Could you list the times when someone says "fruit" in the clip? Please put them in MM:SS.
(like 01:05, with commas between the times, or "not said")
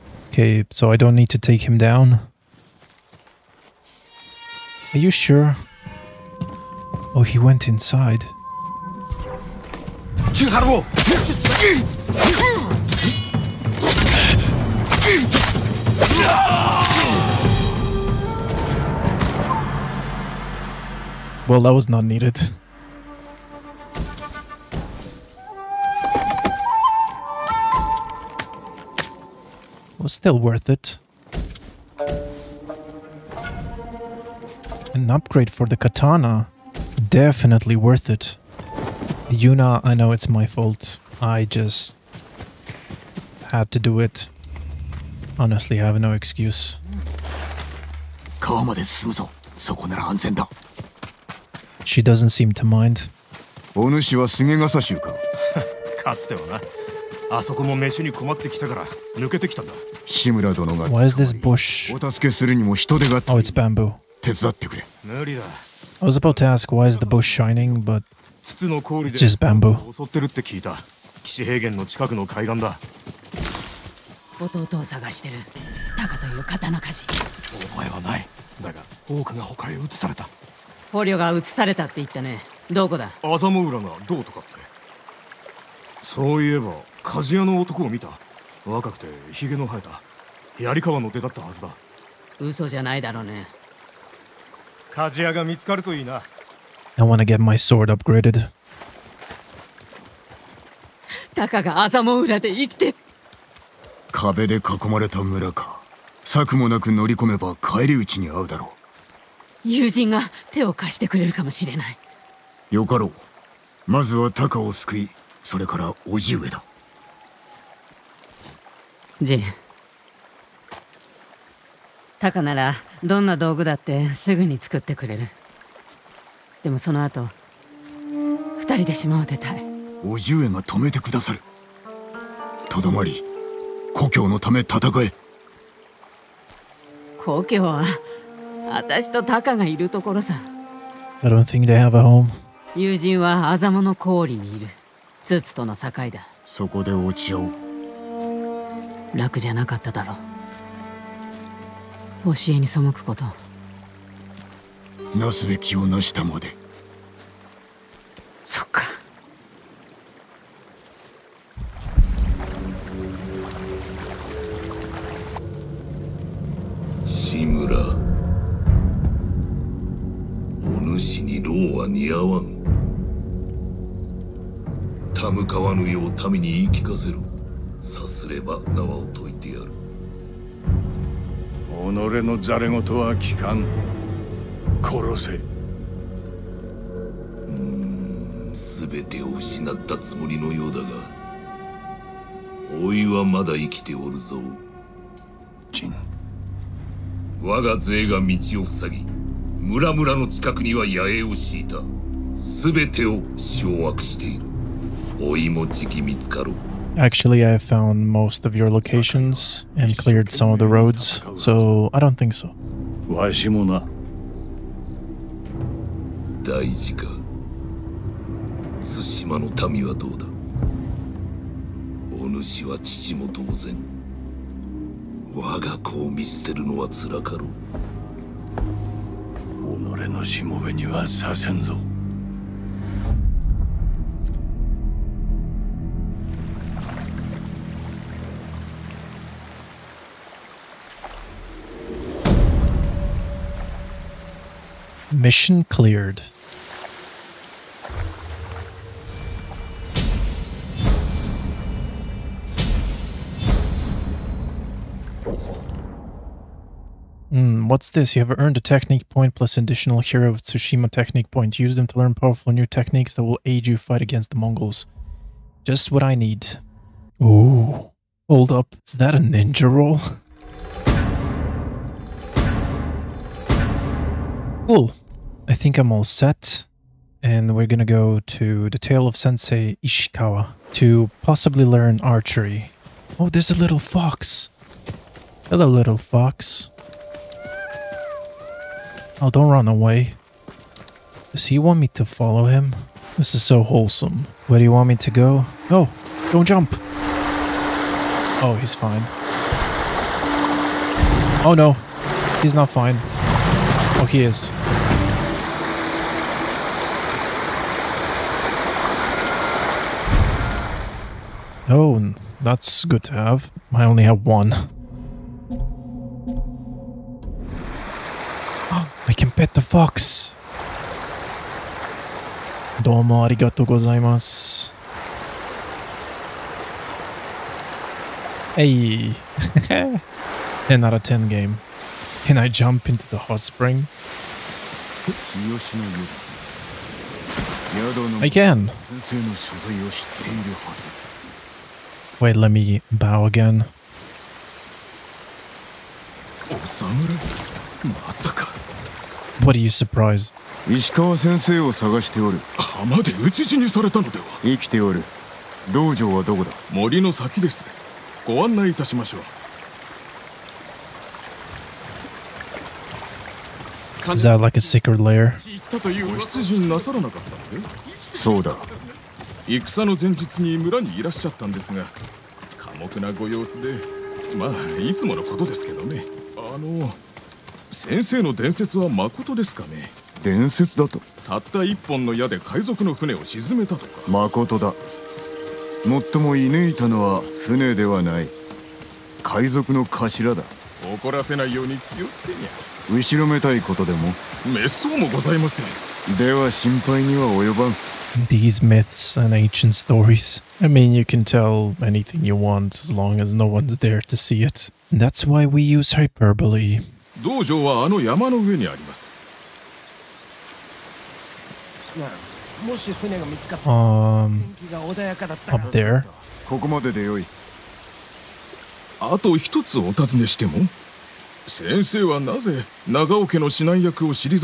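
not said.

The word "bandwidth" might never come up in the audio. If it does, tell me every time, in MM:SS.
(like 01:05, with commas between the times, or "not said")
not said.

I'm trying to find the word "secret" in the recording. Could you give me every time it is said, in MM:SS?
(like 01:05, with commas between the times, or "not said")
06:04.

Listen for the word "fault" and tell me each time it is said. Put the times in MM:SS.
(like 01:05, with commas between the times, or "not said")
00:40.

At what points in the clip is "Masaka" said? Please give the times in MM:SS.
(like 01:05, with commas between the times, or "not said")
05:48.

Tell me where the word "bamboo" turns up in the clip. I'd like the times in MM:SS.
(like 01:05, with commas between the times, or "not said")
01:03, 01:09.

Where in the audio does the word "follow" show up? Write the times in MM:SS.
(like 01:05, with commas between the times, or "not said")
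04:52.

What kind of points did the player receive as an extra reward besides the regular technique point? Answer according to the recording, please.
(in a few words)
Hero of Tsushima.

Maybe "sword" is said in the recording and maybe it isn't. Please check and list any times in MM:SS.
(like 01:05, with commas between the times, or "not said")
01:37.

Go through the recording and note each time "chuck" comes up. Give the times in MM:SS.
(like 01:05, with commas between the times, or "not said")
not said.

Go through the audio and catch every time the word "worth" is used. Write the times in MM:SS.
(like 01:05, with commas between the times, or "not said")
00:30, 00:37.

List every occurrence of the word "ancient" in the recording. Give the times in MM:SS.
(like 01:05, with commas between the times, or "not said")
06:39.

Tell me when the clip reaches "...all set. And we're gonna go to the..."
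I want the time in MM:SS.
04:35.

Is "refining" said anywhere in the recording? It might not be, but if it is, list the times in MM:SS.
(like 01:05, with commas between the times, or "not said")
not said.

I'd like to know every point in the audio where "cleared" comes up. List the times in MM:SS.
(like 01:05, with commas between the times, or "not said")
03:29, 04:05.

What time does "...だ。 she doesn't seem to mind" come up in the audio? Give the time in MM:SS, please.
00:50.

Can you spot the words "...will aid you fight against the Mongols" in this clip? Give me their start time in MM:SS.
04:23.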